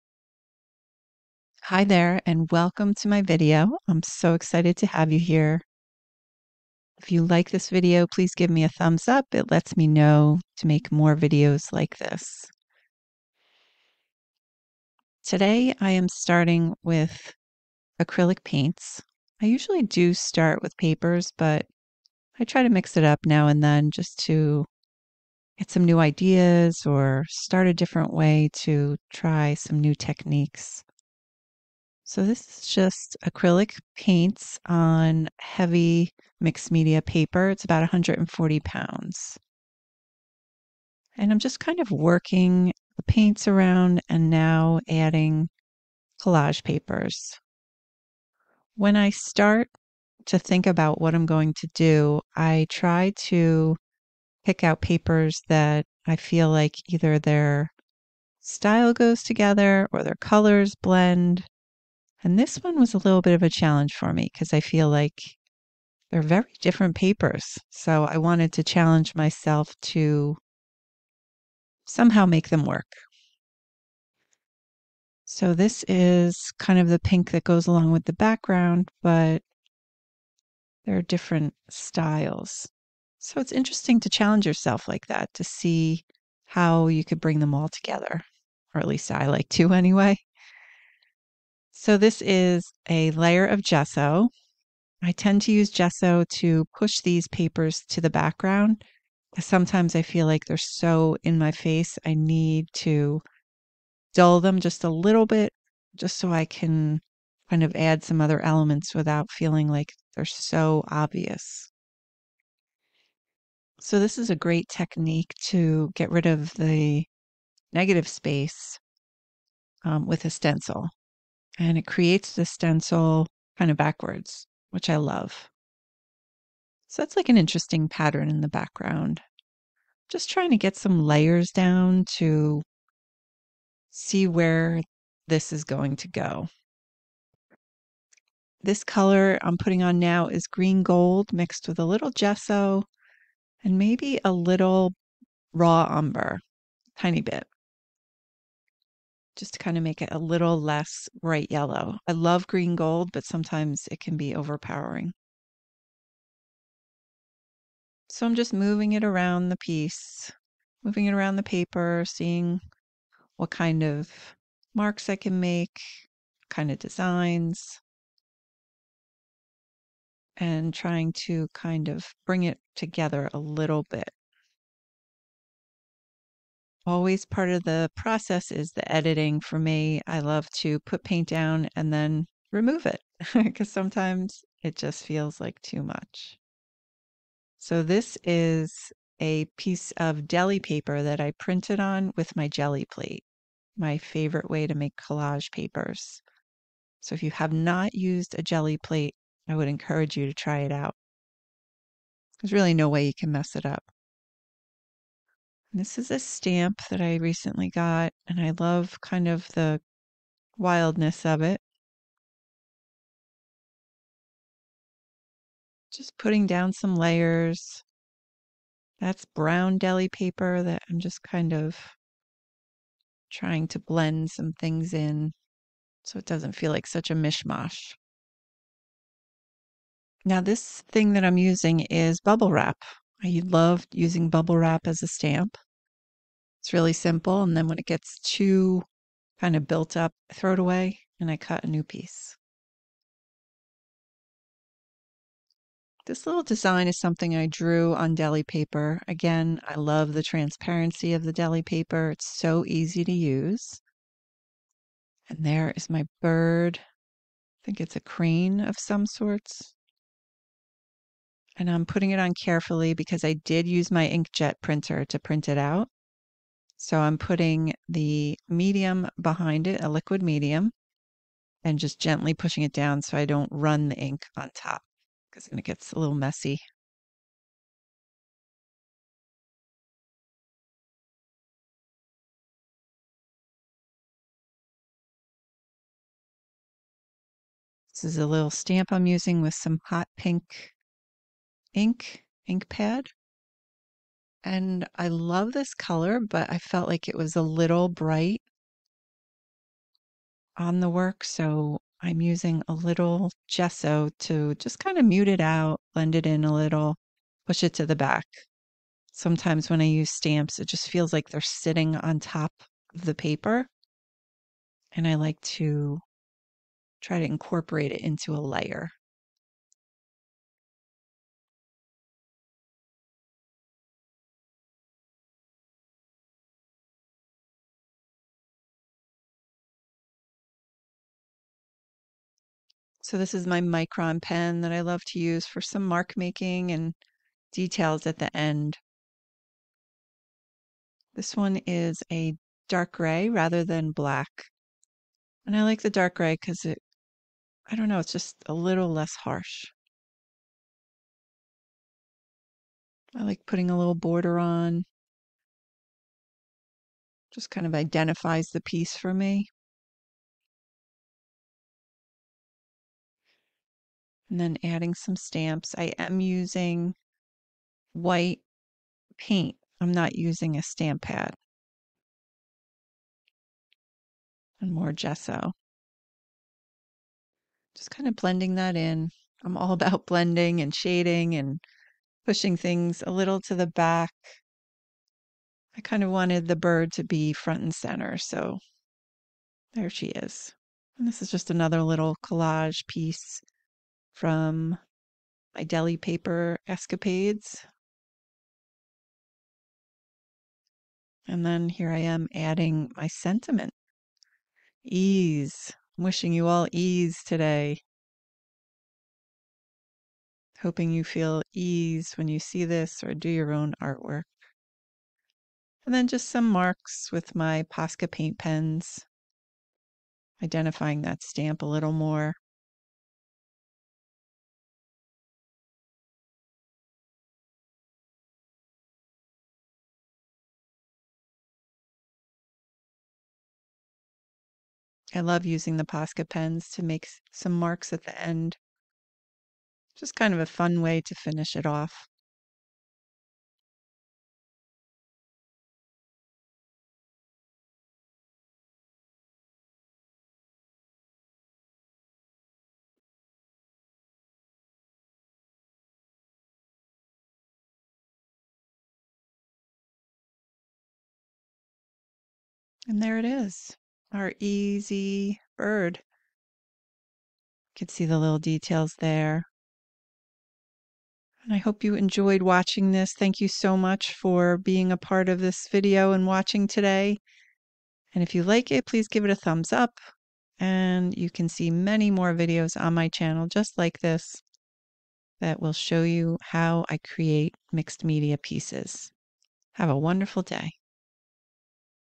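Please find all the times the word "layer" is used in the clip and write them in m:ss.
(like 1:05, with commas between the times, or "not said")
1:33, 2:11, 3:36, 5:18.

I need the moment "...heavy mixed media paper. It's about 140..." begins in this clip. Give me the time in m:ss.
0:35.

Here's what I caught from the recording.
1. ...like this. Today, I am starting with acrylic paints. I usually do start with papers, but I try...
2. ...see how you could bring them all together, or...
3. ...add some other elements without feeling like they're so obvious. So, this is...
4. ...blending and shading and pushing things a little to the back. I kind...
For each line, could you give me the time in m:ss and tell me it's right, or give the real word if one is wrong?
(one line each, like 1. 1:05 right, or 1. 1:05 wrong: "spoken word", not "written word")
1. 0:11 right
2. 1:25 right
3. 1:47 right
4. 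6:20 right.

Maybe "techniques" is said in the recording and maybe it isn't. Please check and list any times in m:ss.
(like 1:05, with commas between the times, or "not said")
0:29, 1:54.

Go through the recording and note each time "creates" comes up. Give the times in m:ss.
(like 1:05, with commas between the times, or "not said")
2:01, 8:06.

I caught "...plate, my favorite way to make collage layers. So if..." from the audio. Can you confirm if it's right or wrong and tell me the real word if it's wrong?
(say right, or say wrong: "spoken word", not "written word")
wrong: "papers", not "layers".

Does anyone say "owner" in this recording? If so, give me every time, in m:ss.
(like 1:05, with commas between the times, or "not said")
not said.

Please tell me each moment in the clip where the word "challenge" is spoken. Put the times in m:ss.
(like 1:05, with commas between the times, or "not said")
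1:03, 1:08, 1:24.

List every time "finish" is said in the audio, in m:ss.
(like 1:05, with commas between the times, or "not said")
7:21.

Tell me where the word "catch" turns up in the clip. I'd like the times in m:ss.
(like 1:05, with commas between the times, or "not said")
not said.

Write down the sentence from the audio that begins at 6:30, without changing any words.
And this is just another little collage piece from my deli paper escapades.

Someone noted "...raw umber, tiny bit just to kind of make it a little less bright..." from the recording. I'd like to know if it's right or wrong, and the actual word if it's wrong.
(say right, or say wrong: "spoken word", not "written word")
right.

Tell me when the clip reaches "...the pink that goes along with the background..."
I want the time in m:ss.
1:16.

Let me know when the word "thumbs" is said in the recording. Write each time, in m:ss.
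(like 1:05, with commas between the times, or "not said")
0:08, 7:59.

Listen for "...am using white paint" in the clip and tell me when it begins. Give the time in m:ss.
6:05.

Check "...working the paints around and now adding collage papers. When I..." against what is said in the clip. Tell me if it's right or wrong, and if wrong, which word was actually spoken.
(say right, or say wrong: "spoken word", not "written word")
right.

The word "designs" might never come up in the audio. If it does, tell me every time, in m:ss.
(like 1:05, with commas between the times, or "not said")
2:46, 4:06.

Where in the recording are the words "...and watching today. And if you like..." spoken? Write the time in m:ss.
7:56.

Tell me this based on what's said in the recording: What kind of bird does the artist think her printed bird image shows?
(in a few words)
A crane.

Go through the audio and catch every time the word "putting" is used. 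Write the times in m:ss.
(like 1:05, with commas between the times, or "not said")
2:19, 3:36, 4:21, 4:27, 5:53.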